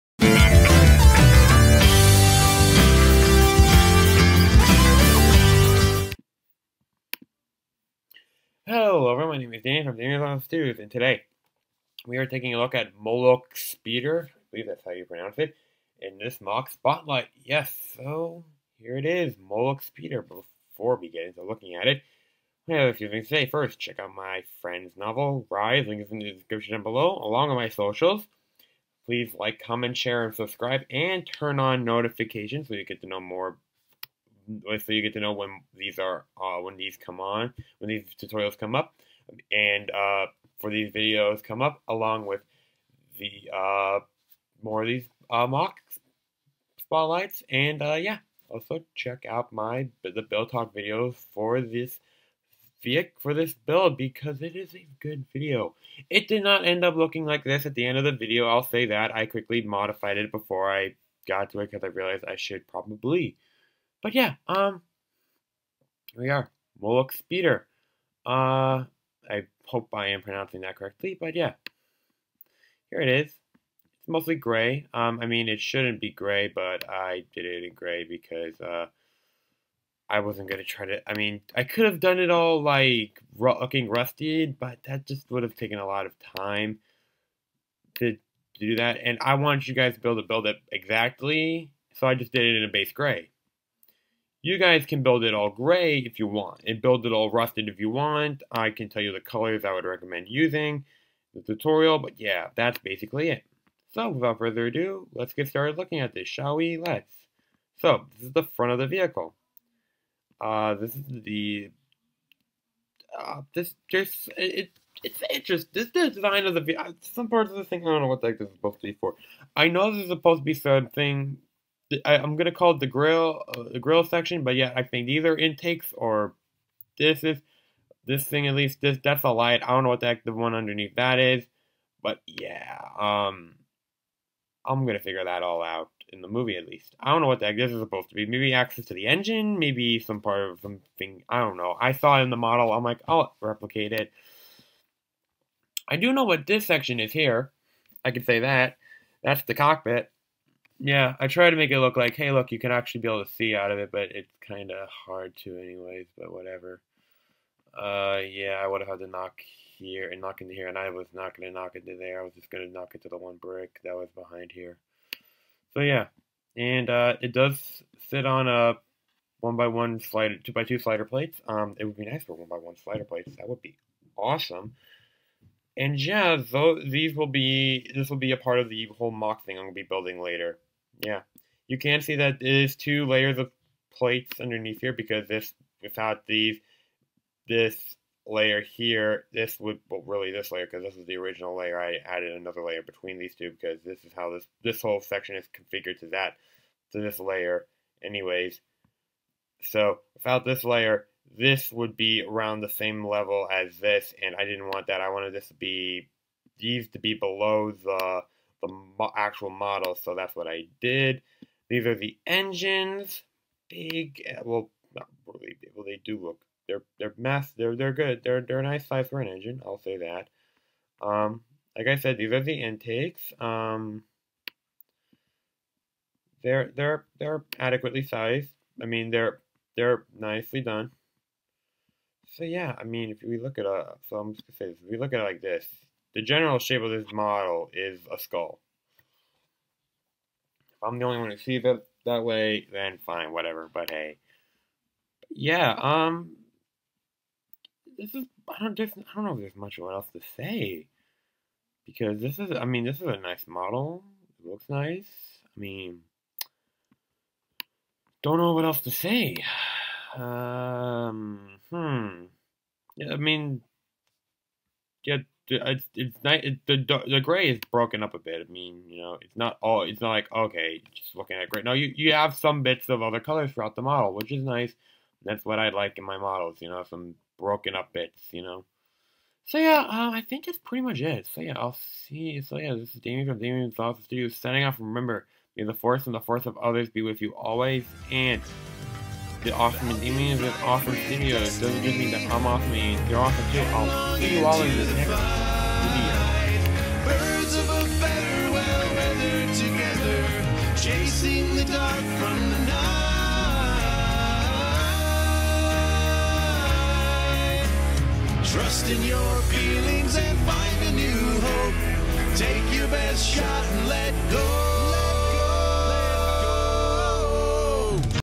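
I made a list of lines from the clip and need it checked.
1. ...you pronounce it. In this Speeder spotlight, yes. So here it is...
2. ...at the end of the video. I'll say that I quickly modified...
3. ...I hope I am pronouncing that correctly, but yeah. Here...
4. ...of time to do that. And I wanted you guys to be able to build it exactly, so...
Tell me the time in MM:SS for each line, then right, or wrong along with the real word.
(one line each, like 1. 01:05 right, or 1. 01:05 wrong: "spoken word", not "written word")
1. 00:14 wrong: "MOC", not "Speeder"
2. 00:57 right
3. 01:09 right
4. 01:26 right.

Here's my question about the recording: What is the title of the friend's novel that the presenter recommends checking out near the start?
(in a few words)
Rise.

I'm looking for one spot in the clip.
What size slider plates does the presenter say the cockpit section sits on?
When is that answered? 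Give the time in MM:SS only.
02:50.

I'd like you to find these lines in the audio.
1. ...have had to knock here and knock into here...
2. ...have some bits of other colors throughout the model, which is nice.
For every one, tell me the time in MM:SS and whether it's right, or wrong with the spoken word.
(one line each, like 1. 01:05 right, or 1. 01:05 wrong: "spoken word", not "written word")
1. 02:38 right
2. 04:32 right.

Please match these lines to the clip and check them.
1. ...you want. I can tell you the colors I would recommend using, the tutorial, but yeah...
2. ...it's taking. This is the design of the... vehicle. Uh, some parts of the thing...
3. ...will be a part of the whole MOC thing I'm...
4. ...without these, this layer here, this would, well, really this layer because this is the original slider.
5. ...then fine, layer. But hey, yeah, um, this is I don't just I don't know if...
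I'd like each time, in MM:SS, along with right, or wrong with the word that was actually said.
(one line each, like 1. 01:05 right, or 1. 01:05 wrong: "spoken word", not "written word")
1. 01:37 right
2. 01:55 wrong: "interesting", not "taking"
3. 02:58 right
4. 03:05 wrong: "layer", not "slider"
5. 04:02 wrong: "whatever", not "layer".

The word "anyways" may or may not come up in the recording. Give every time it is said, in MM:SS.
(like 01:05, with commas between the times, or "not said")
02:35, 03:18.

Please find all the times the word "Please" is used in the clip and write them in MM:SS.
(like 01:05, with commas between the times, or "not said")
00:29.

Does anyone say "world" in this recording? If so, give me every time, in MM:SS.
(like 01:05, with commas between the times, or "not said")
not said.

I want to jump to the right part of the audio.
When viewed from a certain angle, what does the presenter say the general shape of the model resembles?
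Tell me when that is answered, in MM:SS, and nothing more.
03:58.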